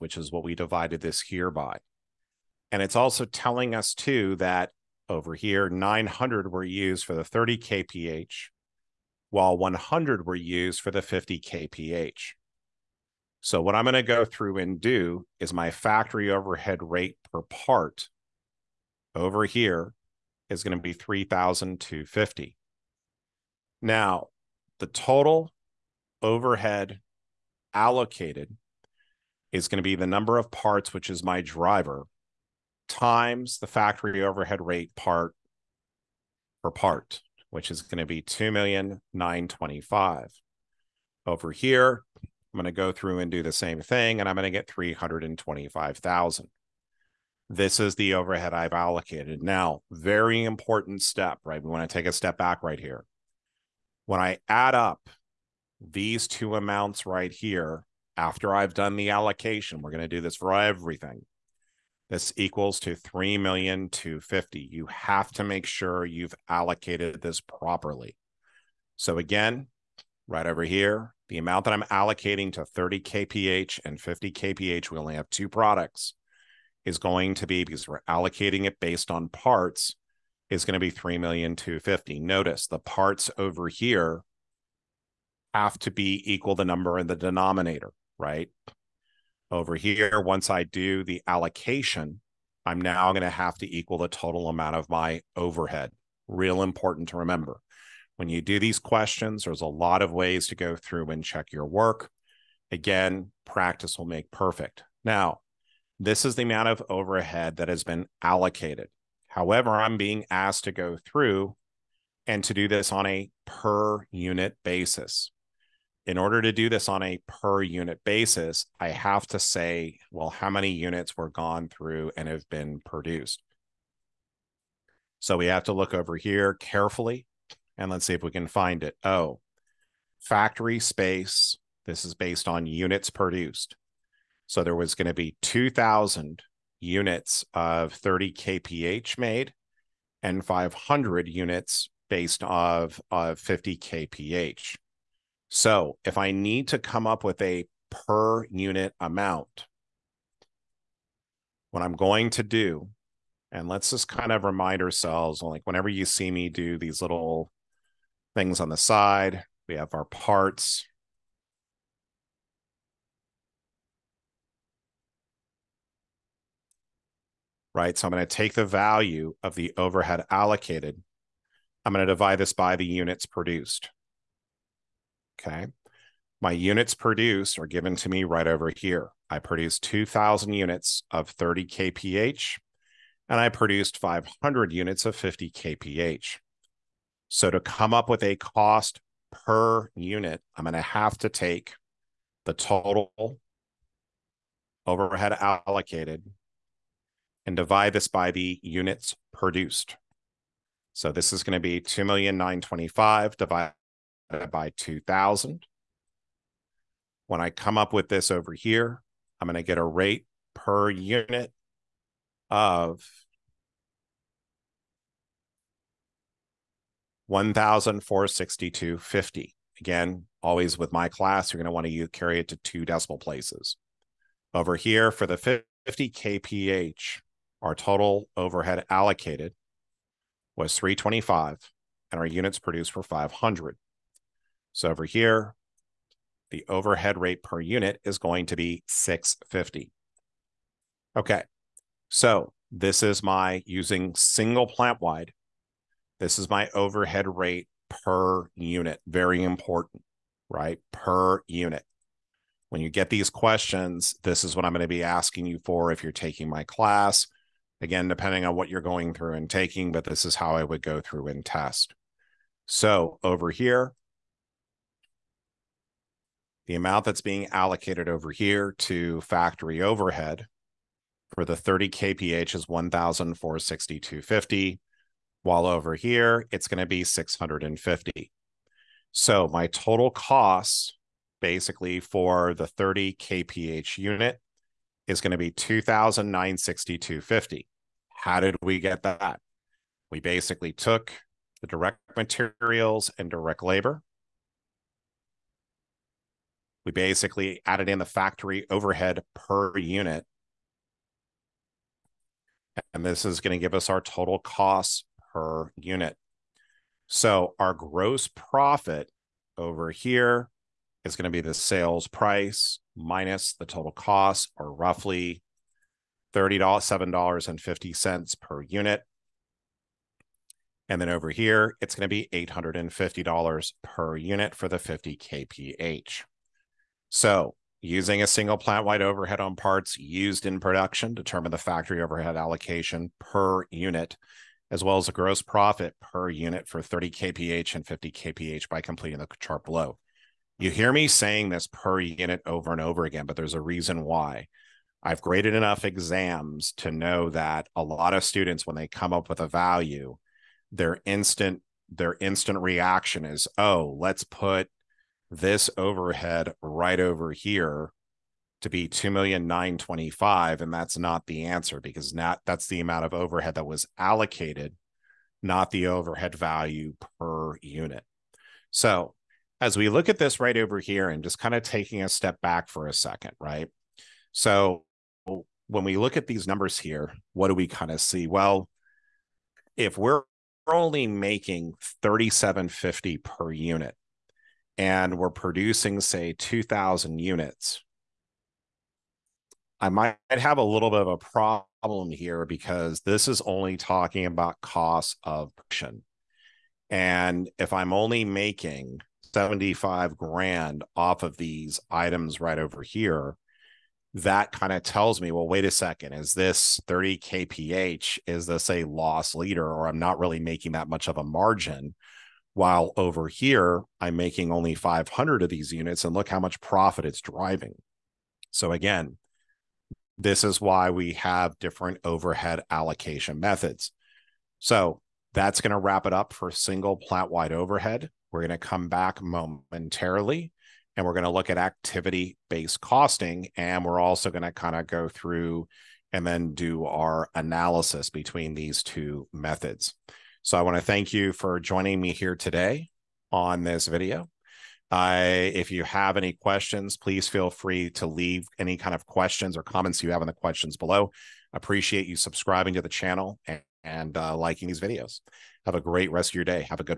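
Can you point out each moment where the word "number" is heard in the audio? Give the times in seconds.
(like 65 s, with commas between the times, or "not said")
30 s, 86 s, 376 s.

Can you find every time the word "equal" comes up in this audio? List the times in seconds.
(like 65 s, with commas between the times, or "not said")
62 s, 86 s, 93 s.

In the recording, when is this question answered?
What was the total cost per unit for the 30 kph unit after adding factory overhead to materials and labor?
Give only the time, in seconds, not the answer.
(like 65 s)
285 s.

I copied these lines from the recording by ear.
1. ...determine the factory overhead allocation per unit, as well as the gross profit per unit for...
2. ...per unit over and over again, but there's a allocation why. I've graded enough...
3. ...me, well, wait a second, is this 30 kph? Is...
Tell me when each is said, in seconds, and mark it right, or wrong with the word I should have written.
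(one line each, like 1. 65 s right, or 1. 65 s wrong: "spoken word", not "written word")
1. 331 s right
2. 341 s wrong: "reason", not "allocation"
3. 405 s right.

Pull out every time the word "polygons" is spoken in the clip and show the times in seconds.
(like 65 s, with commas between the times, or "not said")
not said.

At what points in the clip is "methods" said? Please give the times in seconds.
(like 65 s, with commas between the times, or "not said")
423 s, 439 s.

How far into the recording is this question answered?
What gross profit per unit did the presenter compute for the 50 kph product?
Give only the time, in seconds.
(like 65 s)
322 s.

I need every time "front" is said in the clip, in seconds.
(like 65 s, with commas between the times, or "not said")
not said.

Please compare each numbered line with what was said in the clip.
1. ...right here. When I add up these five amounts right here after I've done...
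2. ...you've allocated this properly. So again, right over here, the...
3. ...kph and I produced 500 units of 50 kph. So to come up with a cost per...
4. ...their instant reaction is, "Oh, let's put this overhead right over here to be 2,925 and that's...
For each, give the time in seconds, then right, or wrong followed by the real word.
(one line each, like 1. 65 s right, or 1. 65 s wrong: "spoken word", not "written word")
1. 52 s wrong: "two", not "five"
2. 66 s right
3. 181 s right
4. 351 s right.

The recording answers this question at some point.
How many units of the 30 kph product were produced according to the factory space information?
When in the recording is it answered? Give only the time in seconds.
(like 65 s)
134 s.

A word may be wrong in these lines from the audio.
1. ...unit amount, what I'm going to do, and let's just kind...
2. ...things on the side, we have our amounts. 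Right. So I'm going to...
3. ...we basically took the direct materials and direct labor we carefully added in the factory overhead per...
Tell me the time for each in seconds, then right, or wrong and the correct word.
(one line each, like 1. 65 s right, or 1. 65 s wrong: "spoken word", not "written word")
1. 148 s right
2. 158 s wrong: "parts", not "amounts"
3. 290 s wrong: "basically", not "carefully".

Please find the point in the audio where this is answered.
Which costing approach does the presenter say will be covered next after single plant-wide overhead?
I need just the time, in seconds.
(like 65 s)
431 s.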